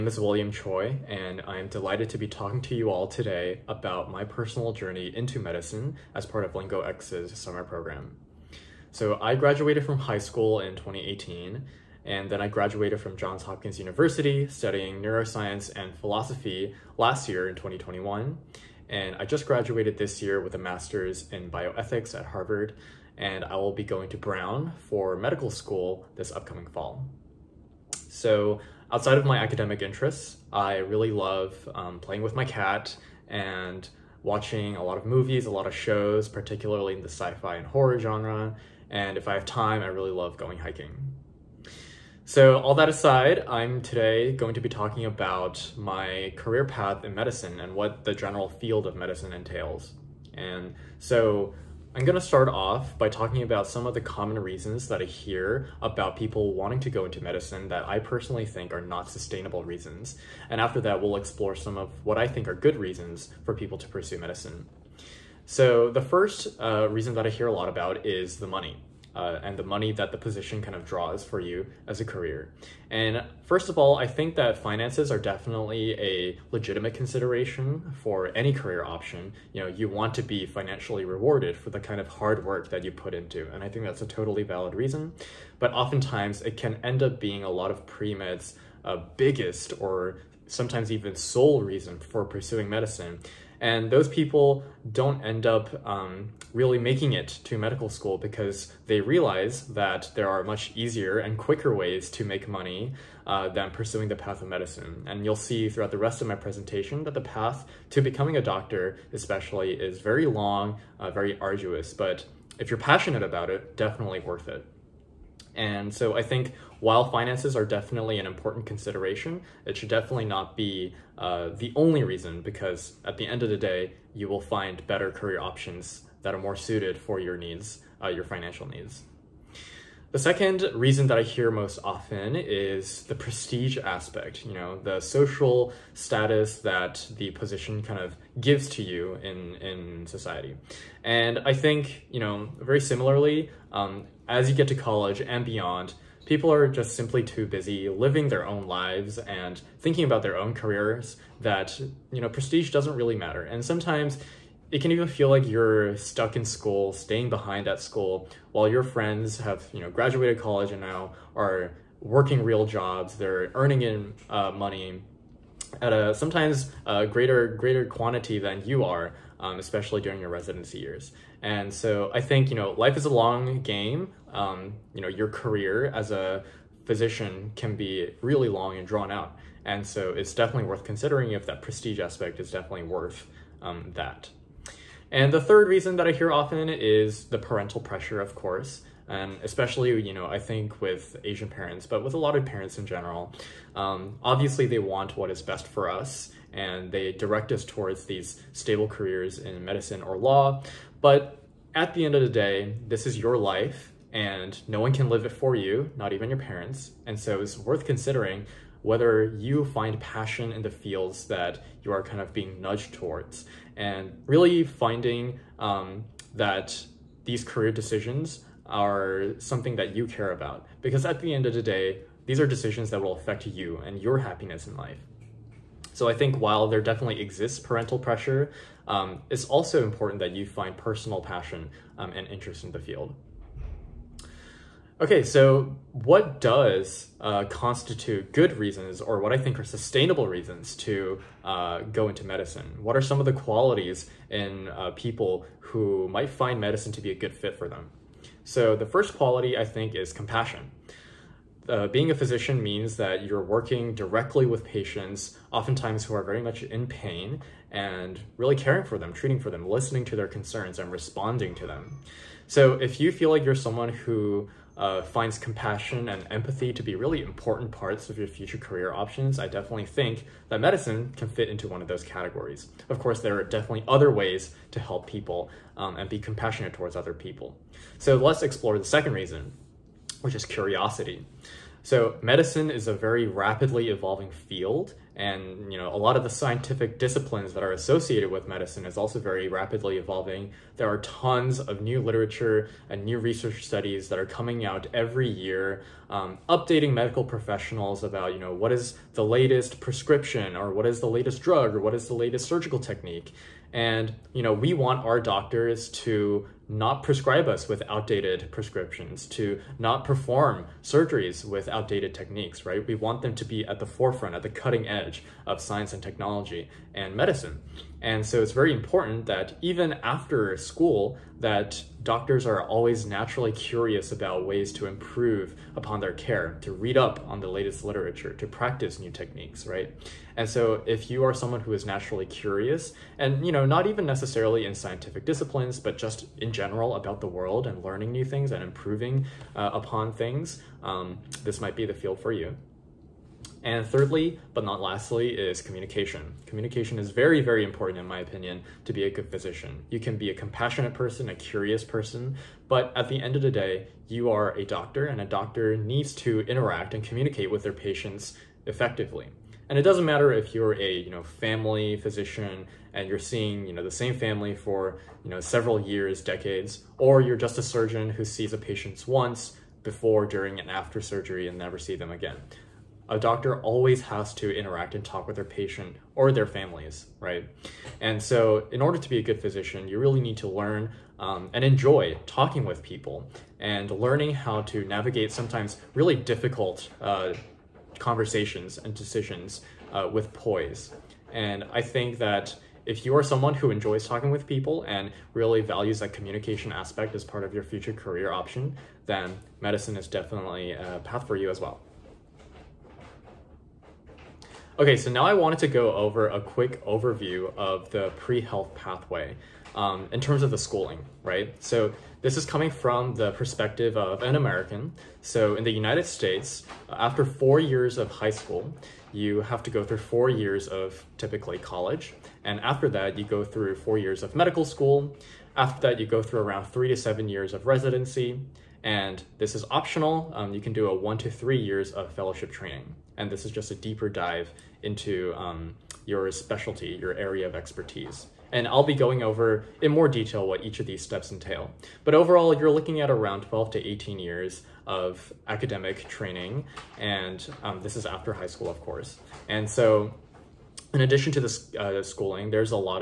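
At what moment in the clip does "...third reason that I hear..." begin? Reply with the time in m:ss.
3:05.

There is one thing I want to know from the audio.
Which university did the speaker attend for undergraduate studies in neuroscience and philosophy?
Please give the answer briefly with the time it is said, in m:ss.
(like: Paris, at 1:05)
Johns Hopkins University, at 0:13.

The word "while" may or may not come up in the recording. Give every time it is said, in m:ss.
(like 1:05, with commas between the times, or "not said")
1:56, 2:38, 3:46.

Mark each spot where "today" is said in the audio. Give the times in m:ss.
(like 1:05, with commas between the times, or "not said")
0:03, 0:43.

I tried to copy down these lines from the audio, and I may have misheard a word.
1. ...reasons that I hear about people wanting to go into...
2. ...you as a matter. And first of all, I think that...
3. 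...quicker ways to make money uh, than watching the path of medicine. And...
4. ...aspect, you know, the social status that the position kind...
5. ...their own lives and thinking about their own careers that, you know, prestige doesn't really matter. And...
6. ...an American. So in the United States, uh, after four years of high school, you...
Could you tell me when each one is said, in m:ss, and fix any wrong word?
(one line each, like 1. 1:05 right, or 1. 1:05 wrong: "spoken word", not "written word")
1. 0:54 right
2. 1:11 wrong: "career", not "matter"
3. 1:41 wrong: "pursuing", not "watching"
4. 2:13 right
5. 2:28 right
6. 6:54 right.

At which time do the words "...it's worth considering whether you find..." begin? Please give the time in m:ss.
3:27.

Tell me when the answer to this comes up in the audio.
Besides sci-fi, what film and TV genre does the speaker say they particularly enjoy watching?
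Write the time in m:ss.
0:37.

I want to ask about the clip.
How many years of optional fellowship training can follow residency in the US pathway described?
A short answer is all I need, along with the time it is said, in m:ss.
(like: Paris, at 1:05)
1 to 3 years, at 7:10.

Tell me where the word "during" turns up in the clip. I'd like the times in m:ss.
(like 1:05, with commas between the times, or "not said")
2:50, 6:10.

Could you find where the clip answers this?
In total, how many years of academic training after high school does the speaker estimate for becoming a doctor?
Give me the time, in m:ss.
7:23.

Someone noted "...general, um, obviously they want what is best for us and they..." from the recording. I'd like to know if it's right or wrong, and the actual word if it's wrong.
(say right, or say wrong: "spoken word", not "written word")
right.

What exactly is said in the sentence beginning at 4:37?
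So let's explore the second reason, which is curiosity.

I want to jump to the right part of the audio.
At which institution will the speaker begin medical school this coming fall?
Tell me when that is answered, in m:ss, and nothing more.
0:24.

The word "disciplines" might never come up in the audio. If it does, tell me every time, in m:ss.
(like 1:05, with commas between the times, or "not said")
4:46, 5:35.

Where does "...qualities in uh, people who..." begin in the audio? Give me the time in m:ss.
4:03.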